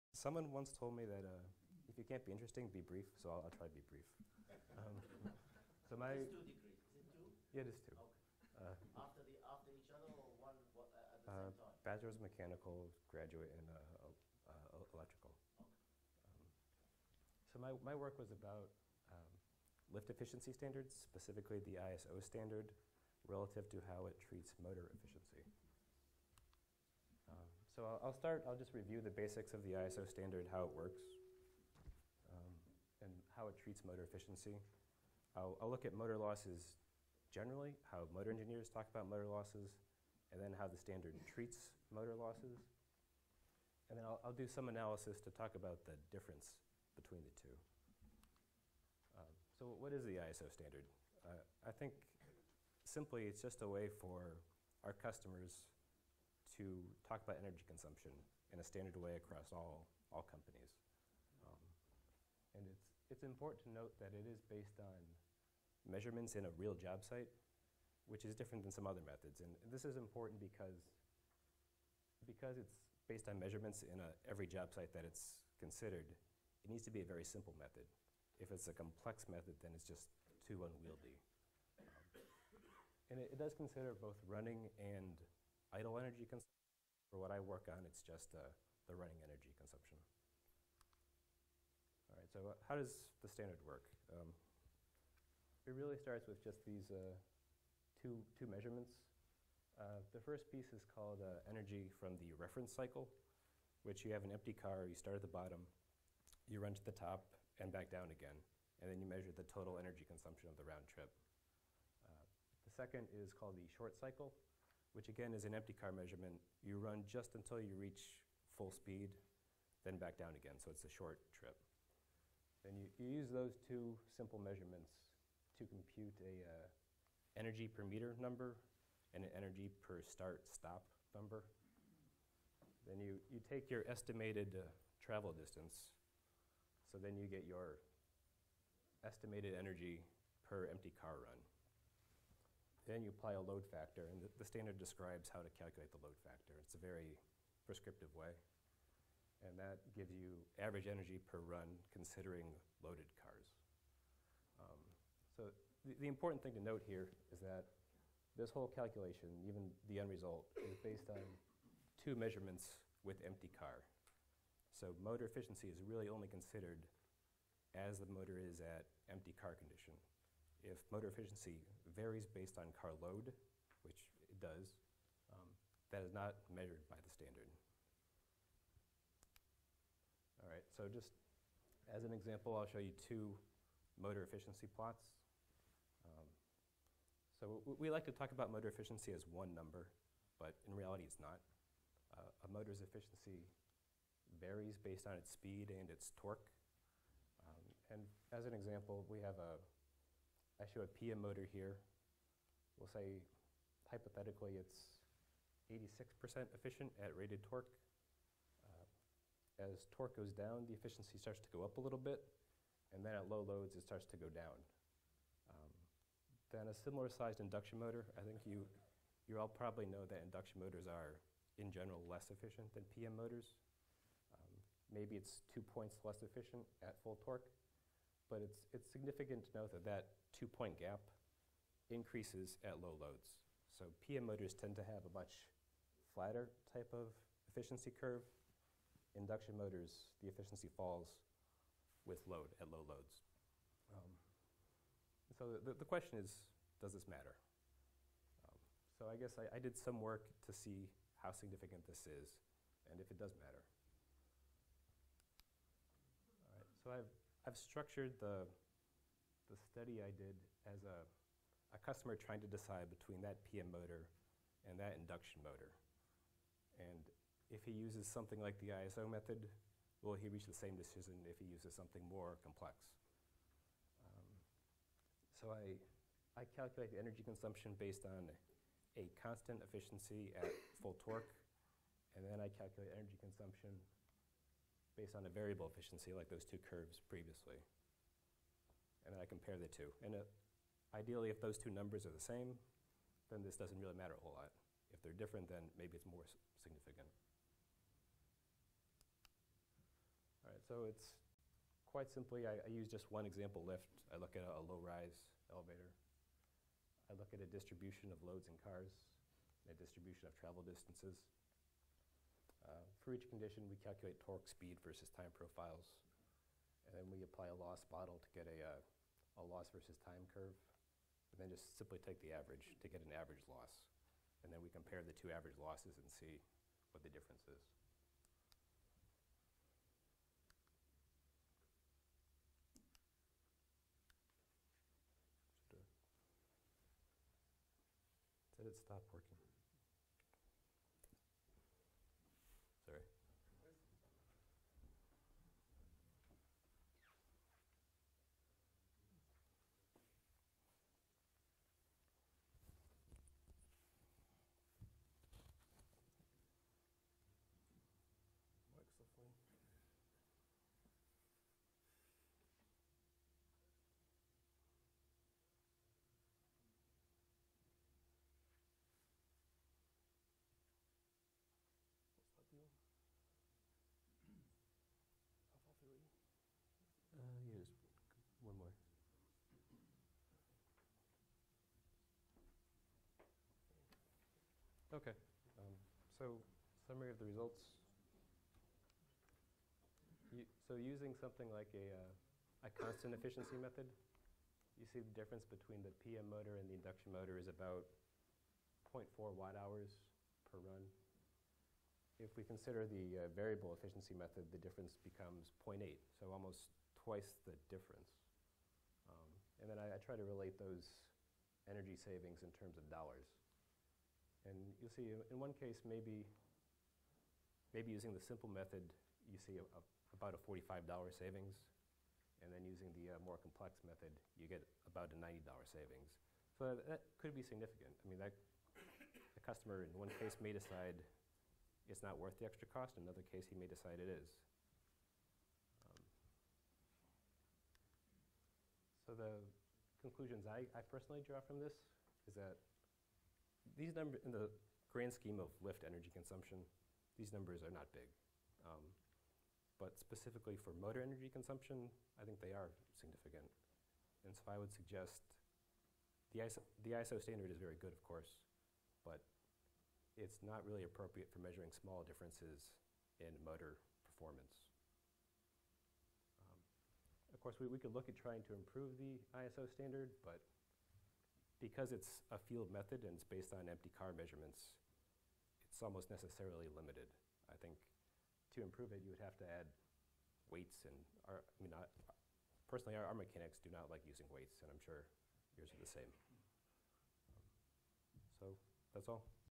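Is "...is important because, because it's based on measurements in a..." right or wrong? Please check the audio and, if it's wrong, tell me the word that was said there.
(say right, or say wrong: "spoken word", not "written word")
right.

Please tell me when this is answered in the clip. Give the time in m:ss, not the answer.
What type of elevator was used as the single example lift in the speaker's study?
5:04.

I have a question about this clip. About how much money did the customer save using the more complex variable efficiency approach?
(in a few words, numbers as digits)
$90.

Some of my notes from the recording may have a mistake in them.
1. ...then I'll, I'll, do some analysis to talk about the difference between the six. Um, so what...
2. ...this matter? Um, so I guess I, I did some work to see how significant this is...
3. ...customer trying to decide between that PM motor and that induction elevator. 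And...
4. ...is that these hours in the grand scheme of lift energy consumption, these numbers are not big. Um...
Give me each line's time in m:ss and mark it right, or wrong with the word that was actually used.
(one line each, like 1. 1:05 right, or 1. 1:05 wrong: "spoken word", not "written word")
1. 0:43 wrong: "two", not "six"
2. 4:06 right
3. 4:21 wrong: "motor", not "elevator"
4. 7:22 wrong: "numbers", not "hours".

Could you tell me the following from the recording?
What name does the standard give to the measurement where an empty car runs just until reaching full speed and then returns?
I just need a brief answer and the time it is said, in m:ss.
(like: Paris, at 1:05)
Short cycle, at 1:53.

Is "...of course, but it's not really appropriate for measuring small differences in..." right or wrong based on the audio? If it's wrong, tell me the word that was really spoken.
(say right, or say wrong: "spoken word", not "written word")
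right.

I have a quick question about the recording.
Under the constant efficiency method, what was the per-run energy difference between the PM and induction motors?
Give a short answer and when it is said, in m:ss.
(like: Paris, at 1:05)
0.4 watt hours, at 6:38.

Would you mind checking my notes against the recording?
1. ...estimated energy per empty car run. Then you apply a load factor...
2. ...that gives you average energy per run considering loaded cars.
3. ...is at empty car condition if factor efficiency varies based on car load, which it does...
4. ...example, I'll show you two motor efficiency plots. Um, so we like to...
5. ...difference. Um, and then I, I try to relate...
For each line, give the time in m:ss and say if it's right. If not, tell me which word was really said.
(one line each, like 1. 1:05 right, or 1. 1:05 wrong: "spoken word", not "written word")
1. 2:19 right
2. 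2:29 right
3. 2:48 wrong: "motor", not "factor"
4. 3:02 right
5. 6:47 right.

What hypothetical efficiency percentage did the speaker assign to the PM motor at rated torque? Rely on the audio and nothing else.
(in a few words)
86%.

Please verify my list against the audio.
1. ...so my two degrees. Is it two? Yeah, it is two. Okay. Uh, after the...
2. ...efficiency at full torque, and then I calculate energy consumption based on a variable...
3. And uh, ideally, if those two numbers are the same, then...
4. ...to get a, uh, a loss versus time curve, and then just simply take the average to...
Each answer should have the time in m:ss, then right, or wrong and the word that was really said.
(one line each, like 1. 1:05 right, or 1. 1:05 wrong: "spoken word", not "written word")
1. 0:05 right
2. 4:39 right
3. 4:50 right
4. 5:18 right.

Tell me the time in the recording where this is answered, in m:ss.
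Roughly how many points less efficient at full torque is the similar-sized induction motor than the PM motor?
3:45.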